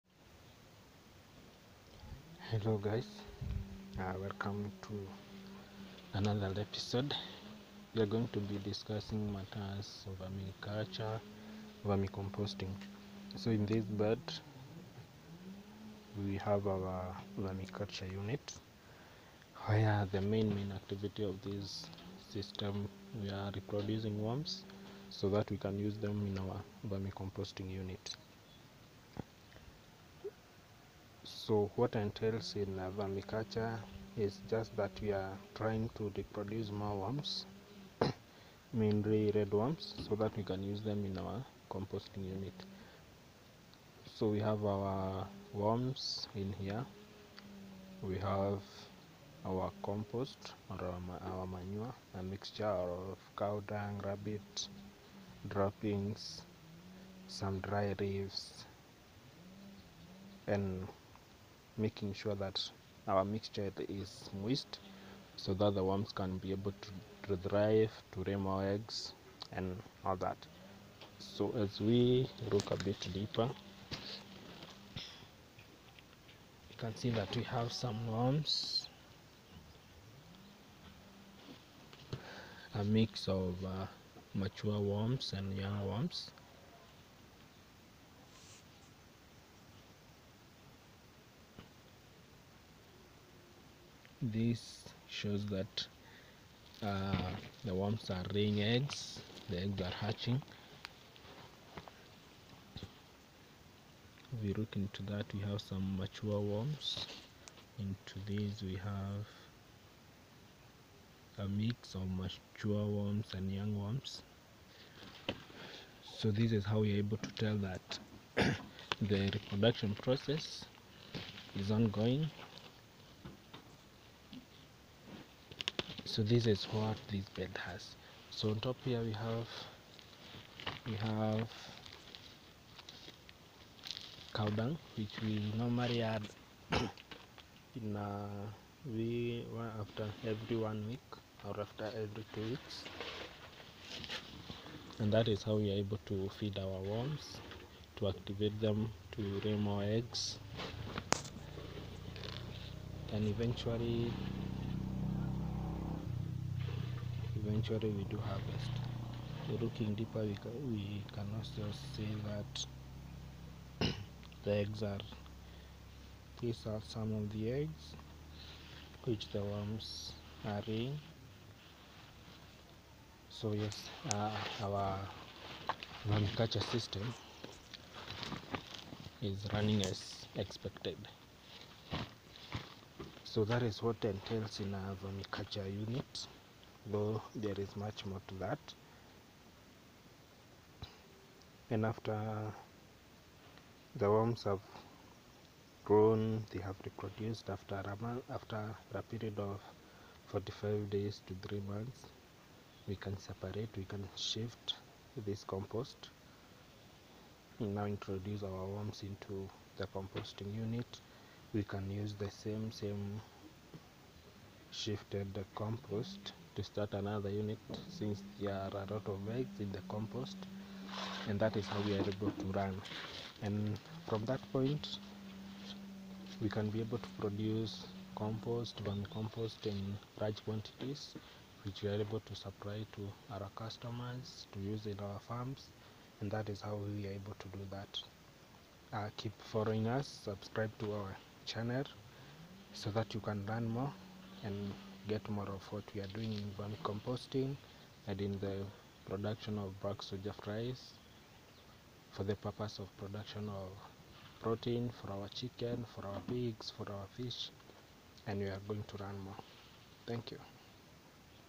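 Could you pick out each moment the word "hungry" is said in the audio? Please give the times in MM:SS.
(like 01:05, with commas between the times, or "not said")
not said.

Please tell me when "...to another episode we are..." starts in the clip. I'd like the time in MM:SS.
00:04.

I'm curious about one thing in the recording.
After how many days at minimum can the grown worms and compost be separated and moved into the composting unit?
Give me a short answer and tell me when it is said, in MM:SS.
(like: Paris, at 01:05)
45 days, at 03:20.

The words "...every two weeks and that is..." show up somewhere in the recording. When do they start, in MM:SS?
02:22.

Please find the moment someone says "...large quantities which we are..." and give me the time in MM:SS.
03:50.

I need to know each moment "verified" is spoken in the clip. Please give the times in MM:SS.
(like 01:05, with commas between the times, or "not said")
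not said.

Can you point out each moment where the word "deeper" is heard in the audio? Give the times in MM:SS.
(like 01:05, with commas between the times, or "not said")
01:13, 02:39.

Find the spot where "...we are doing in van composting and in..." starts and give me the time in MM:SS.
04:05.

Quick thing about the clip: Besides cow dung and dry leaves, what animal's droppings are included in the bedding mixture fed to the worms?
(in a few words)
rabbit.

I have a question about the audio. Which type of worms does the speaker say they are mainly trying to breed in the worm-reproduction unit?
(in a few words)
red worms.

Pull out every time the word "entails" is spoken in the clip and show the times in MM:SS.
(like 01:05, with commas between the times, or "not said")
00:31, 03:04.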